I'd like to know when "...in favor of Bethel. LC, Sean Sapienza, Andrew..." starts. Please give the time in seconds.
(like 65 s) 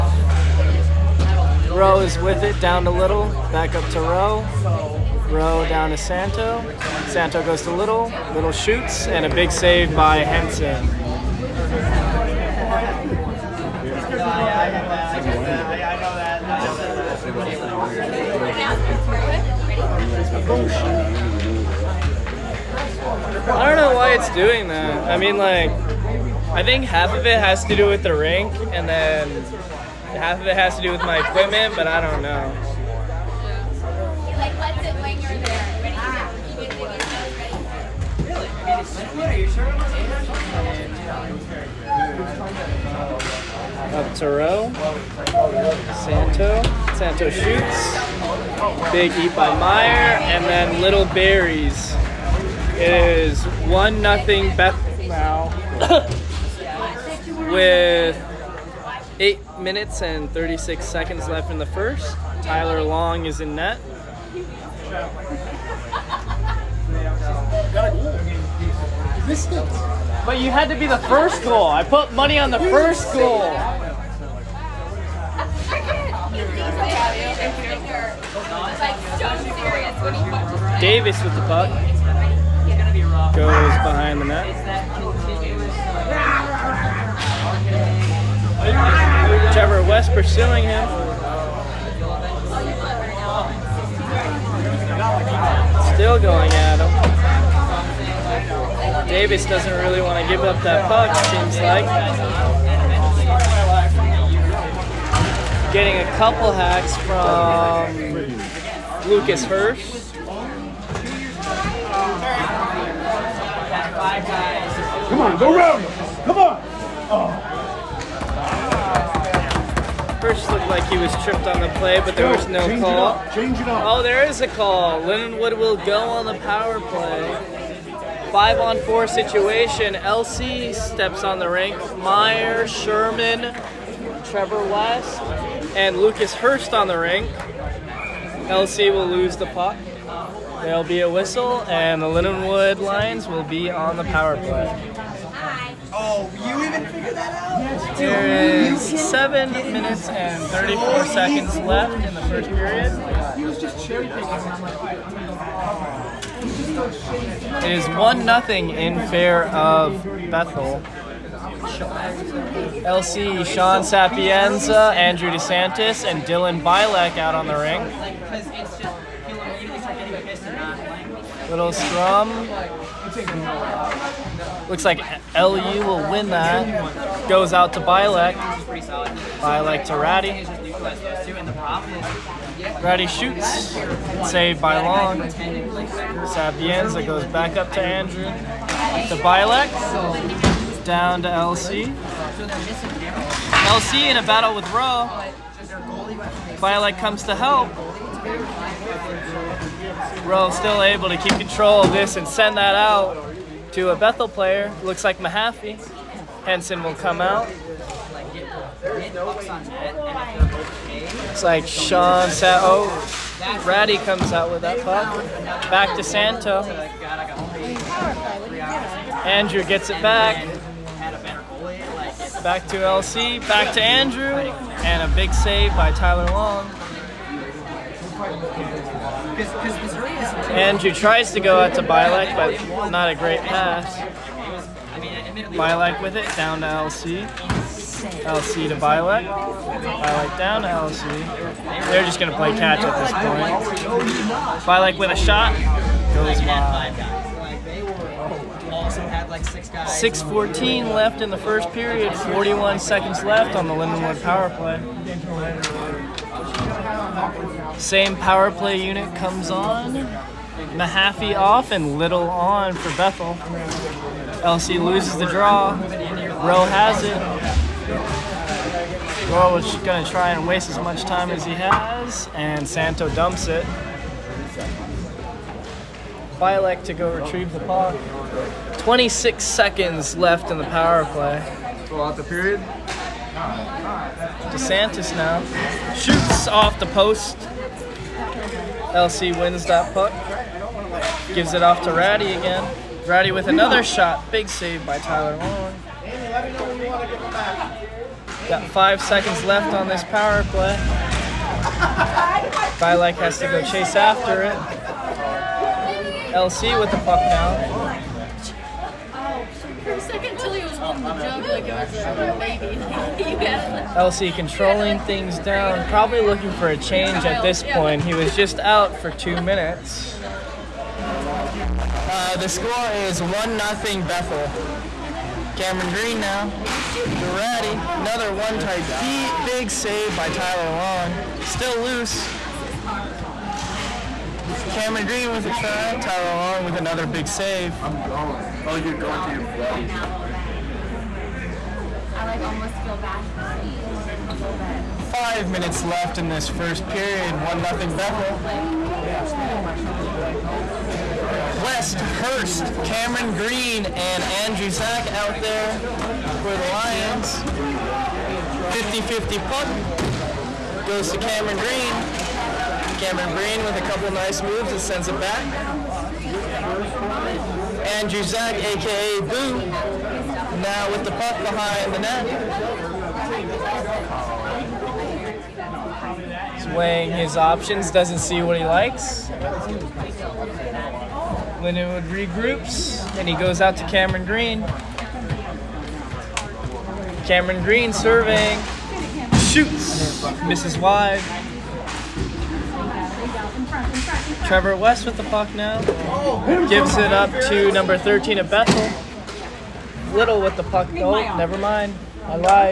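158 s.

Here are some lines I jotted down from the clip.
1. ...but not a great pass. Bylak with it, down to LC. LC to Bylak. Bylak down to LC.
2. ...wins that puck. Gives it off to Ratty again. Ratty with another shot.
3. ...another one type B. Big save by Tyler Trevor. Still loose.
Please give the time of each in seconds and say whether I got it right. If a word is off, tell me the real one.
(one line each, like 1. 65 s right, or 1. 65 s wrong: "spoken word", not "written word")
1. 232 s right
2. 289 s right
3. 328 s wrong: "Long", not "Trevor".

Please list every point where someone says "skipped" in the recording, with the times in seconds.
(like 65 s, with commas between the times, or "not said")
not said.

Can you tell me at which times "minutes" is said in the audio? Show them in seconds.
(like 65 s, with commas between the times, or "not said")
59 s, 149 s, 319 s, 345 s.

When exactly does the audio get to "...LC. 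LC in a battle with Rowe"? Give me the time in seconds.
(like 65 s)
191 s.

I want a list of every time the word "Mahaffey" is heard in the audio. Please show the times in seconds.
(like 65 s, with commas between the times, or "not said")
205 s, 260 s.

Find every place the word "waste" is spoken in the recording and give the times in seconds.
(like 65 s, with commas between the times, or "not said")
270 s.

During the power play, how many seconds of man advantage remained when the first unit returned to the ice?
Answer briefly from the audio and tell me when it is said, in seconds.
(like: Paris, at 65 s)
41, at 252 s.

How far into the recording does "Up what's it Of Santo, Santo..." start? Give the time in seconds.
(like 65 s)
43 s.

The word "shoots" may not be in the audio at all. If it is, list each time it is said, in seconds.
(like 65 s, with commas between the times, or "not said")
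8 s, 47 s, 183 s, 285 s, 389 s.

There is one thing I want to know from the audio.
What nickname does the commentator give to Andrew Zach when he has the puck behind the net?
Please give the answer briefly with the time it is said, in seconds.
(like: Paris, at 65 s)
Boo, at 369 s.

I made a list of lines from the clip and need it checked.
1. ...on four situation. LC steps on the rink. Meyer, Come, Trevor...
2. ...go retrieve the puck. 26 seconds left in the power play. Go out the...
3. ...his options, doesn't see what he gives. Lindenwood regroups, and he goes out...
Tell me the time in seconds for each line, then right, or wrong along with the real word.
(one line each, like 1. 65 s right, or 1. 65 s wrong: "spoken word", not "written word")
1. 128 s wrong: "Sherman", not "Come"
2. 276 s right
3. 377 s wrong: "likes", not "gives".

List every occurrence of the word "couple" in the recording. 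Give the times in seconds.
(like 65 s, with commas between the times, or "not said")
106 s, 363 s.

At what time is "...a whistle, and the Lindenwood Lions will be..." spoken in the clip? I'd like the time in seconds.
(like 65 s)
141 s.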